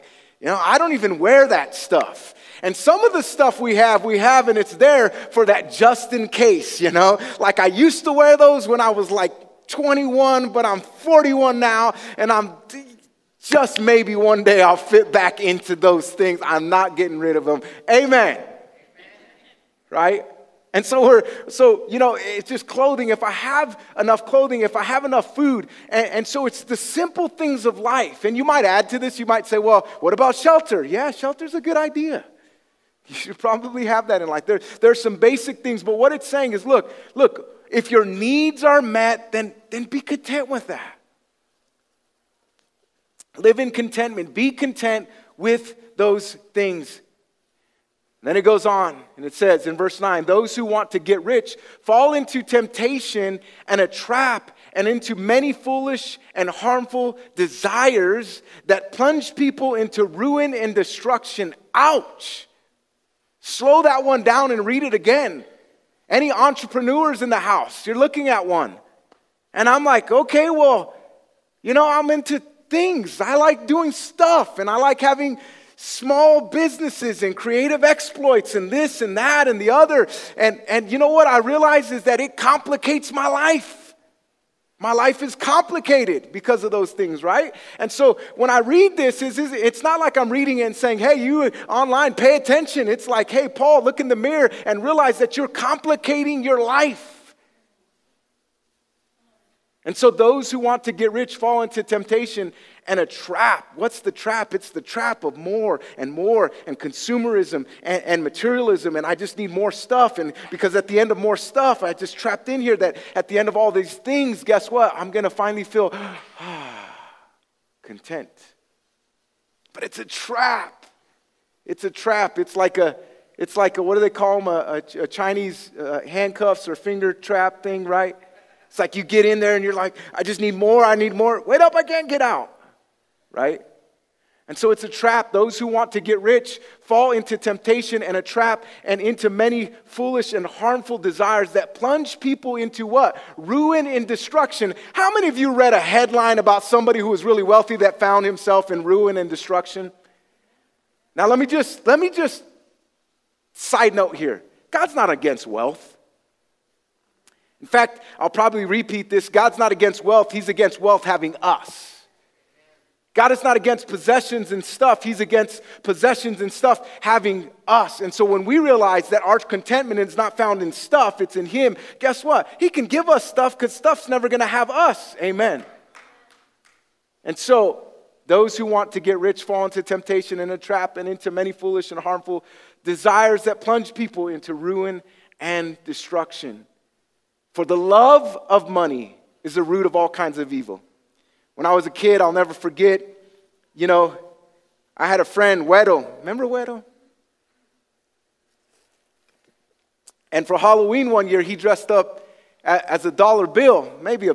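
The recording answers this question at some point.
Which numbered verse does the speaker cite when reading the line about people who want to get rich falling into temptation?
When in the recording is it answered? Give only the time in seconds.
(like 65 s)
49 s.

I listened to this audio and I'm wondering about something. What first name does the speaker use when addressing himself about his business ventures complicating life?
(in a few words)
Paul.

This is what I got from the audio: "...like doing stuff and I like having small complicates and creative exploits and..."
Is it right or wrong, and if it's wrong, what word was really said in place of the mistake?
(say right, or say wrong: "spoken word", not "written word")
wrong: "businesses", not "complicates".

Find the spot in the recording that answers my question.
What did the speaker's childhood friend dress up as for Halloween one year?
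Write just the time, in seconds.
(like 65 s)
203 s.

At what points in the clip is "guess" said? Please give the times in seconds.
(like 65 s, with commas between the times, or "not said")
114 s, 171 s.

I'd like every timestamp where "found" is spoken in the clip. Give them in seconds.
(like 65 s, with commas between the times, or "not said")
147 s, 170 s.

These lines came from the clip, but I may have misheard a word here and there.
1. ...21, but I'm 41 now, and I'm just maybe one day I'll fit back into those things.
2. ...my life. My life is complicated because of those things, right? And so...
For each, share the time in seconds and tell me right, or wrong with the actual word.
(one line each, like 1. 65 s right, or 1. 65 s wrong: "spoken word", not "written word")
1. 9 s right
2. 83 s right.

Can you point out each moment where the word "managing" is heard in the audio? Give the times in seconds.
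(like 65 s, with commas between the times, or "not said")
not said.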